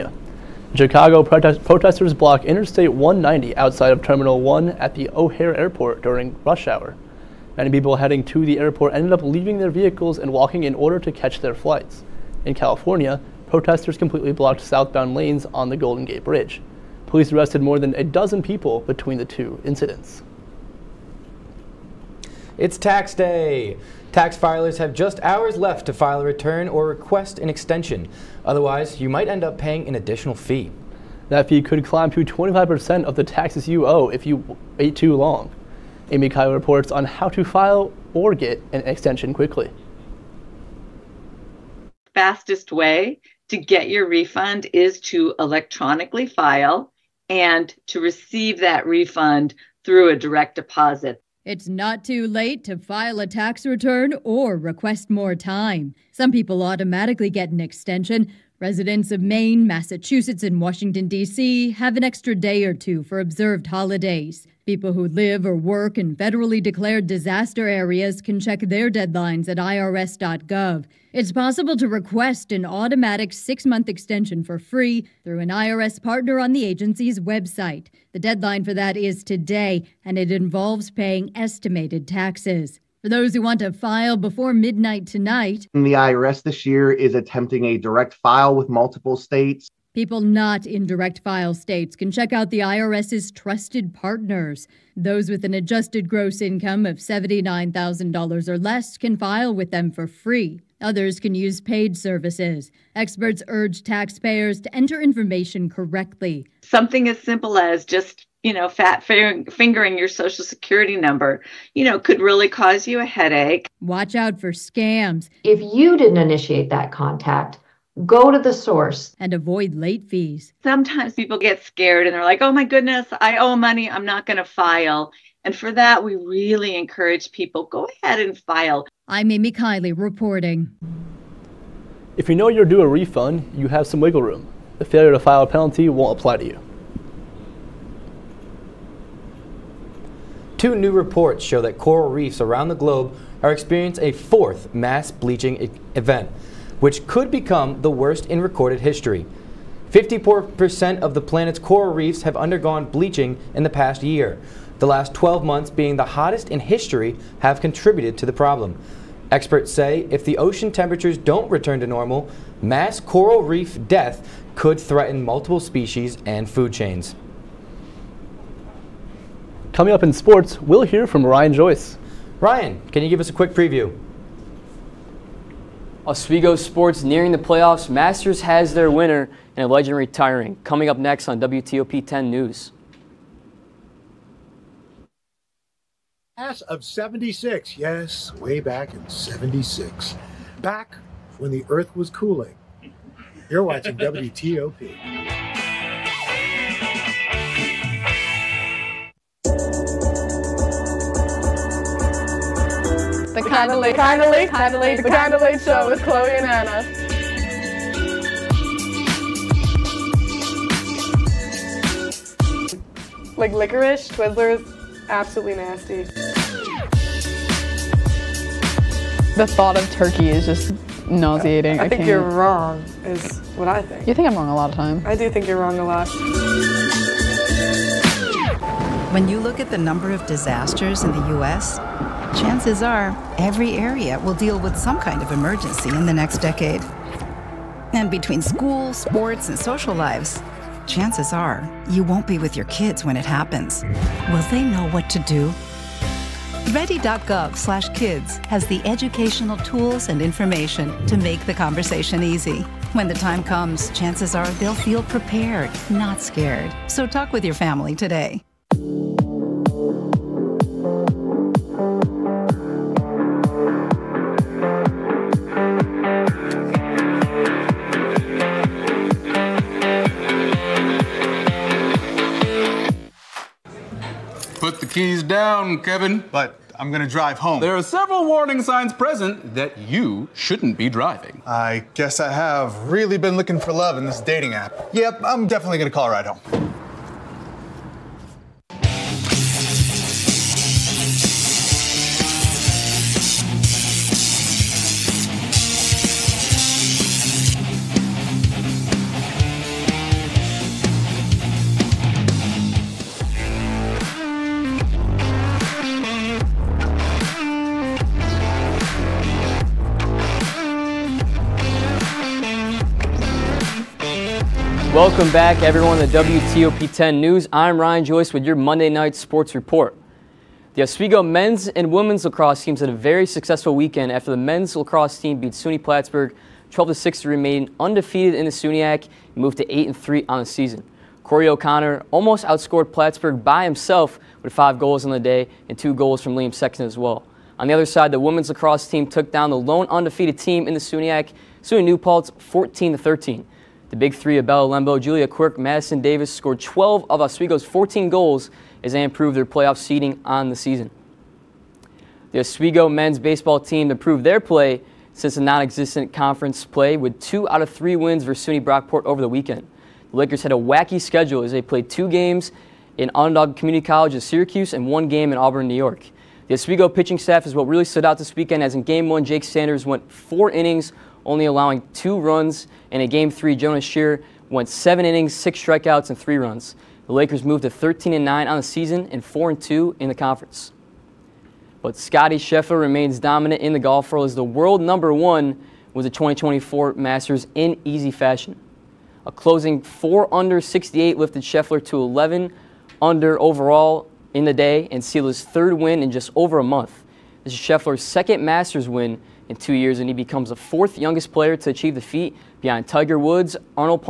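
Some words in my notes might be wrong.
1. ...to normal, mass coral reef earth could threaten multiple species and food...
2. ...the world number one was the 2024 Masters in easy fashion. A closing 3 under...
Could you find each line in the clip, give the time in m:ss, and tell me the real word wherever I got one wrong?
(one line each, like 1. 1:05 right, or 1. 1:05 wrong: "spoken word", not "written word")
1. 2:41 wrong: "death", not "earth"
2. 6:24 wrong: "4", not "3".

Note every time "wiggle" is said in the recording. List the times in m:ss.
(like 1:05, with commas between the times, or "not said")
2:14.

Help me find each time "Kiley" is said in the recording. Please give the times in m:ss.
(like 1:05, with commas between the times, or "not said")
0:36, 2:09.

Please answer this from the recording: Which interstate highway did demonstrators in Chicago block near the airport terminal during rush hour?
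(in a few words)
Interstate 190.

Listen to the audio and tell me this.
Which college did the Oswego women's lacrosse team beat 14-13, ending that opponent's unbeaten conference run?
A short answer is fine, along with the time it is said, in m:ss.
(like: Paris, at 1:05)
SUNY New Paltz, at 5:41.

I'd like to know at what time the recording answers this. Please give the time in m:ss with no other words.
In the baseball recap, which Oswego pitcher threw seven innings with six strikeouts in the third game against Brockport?
6:13.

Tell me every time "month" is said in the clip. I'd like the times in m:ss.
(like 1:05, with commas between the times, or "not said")
1:13, 2:35, 6:36.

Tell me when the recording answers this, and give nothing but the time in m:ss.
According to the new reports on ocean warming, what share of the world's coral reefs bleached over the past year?
2:29.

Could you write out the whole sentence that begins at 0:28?
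Otherwise, you might end up paying an additional fee.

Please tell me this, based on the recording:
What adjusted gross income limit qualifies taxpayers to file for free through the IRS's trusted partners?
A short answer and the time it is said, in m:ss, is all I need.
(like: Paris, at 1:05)
$79,000, at 1:36.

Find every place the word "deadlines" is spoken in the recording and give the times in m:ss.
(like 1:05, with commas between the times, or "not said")
1:08, 1:18.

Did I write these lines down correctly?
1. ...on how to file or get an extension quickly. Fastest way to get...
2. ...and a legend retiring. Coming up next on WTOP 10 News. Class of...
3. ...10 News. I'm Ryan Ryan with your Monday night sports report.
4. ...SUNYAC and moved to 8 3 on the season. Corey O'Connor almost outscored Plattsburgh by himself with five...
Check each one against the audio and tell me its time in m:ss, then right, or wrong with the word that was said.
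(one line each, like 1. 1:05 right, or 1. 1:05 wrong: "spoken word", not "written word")
1. 0:36 right
2. 2:59 right
3. 5:16 wrong: "Joyce", not "Ryan"
4. 5:28 right.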